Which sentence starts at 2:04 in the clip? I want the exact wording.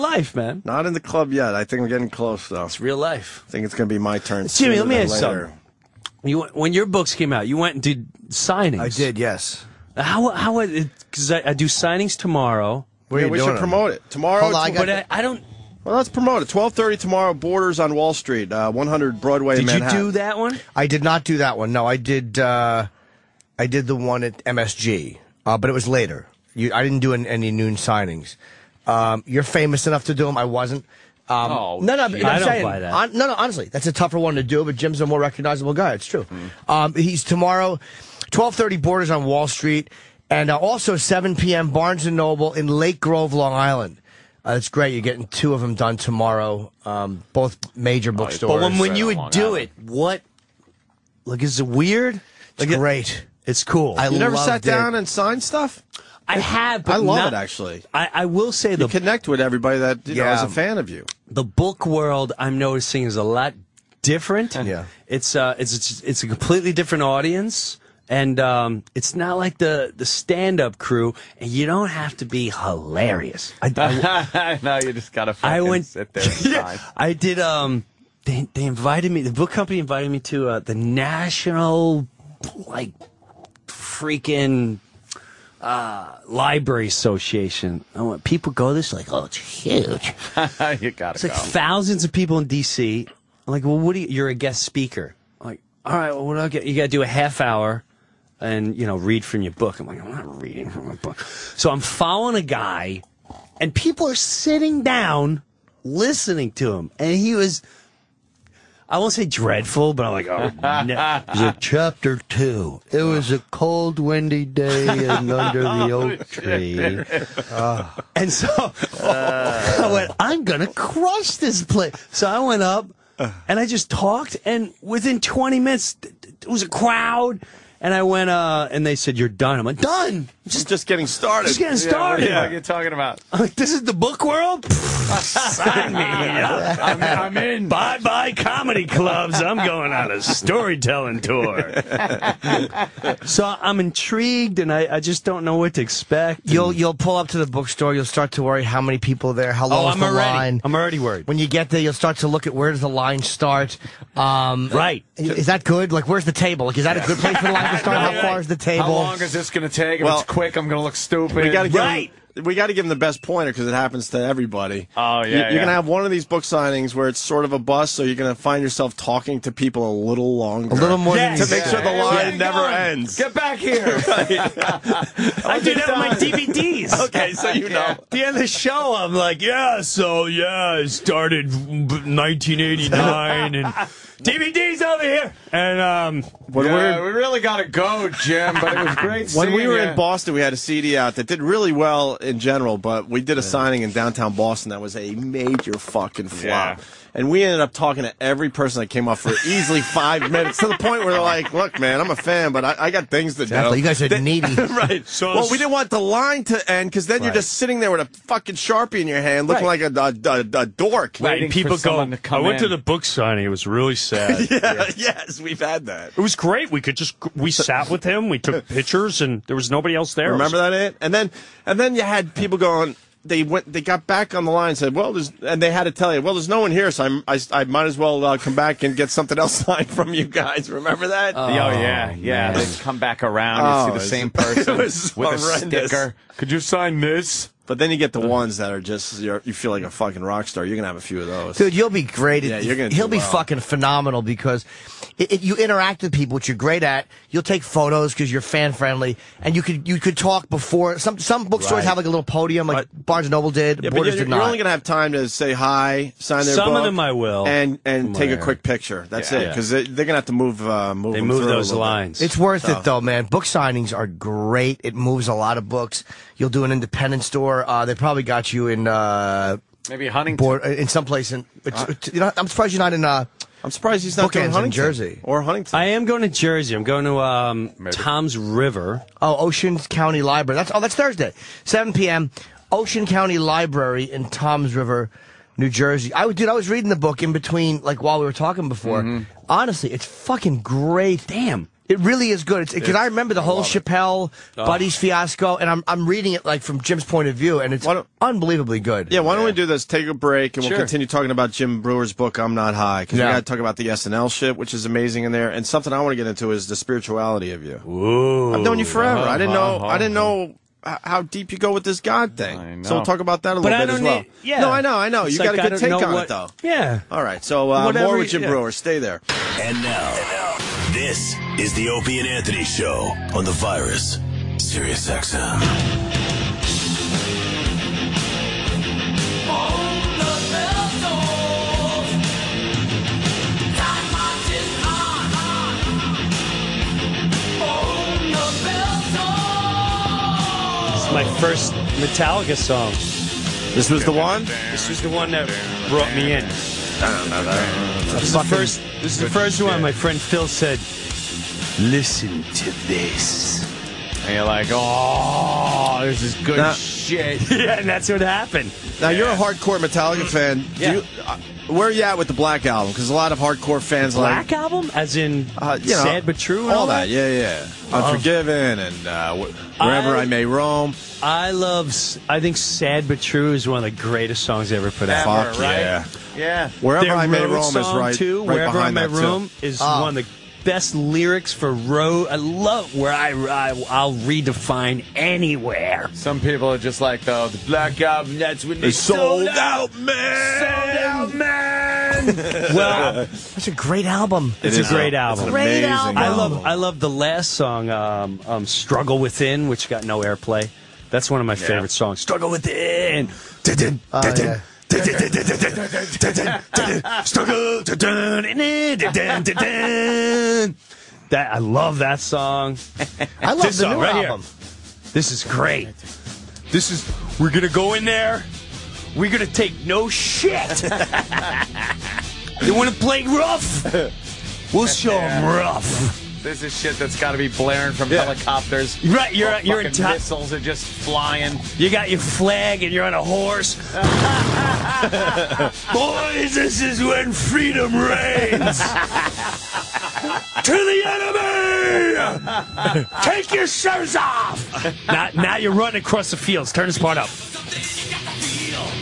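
And within 20 minutes, it was a crowd.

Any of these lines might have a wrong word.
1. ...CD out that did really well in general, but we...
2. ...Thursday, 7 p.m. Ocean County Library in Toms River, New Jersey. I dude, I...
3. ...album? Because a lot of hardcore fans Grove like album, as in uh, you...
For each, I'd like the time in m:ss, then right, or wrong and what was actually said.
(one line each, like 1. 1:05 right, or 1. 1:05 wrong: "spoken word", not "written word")
1. 3:10 right
2. 4:40 right
3. 6:02 wrong: "Black", not "Grove".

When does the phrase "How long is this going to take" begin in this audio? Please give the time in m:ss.
2:38.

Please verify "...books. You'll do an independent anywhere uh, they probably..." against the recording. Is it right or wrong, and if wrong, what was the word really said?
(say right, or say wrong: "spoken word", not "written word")
wrong: "store", not "anywhere".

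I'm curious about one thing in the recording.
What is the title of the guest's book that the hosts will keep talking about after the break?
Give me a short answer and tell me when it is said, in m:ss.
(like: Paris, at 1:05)
I'm Not High, at 5:02.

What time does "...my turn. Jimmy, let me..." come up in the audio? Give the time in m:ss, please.
0:03.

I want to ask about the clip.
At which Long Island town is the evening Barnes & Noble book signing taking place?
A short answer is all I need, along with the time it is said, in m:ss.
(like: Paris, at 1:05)
Lake Grove, at 0:42.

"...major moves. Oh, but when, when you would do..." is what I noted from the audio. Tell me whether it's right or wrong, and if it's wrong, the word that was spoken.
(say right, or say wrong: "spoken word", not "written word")
wrong: "bookstores", not "moves".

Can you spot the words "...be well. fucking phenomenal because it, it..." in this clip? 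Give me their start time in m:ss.
4:03.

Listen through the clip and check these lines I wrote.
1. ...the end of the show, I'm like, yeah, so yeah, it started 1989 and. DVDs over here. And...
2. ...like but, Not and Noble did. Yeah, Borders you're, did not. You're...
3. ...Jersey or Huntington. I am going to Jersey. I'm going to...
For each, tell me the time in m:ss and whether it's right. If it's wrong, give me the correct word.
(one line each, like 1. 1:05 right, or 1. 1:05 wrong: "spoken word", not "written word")
1. 2:58 right
2. 4:12 wrong: "Barnes", not "Not"
3. 4:34 right.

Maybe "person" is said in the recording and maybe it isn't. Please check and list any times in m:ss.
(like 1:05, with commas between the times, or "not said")
3:18, 3:54.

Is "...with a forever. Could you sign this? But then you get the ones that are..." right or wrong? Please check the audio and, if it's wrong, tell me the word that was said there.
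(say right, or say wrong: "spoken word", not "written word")
wrong: "sticker", not "forever".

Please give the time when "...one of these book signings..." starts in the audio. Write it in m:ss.
2:45.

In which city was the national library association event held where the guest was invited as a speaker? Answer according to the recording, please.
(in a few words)
D.C.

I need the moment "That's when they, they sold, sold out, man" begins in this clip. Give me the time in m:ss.
6:28.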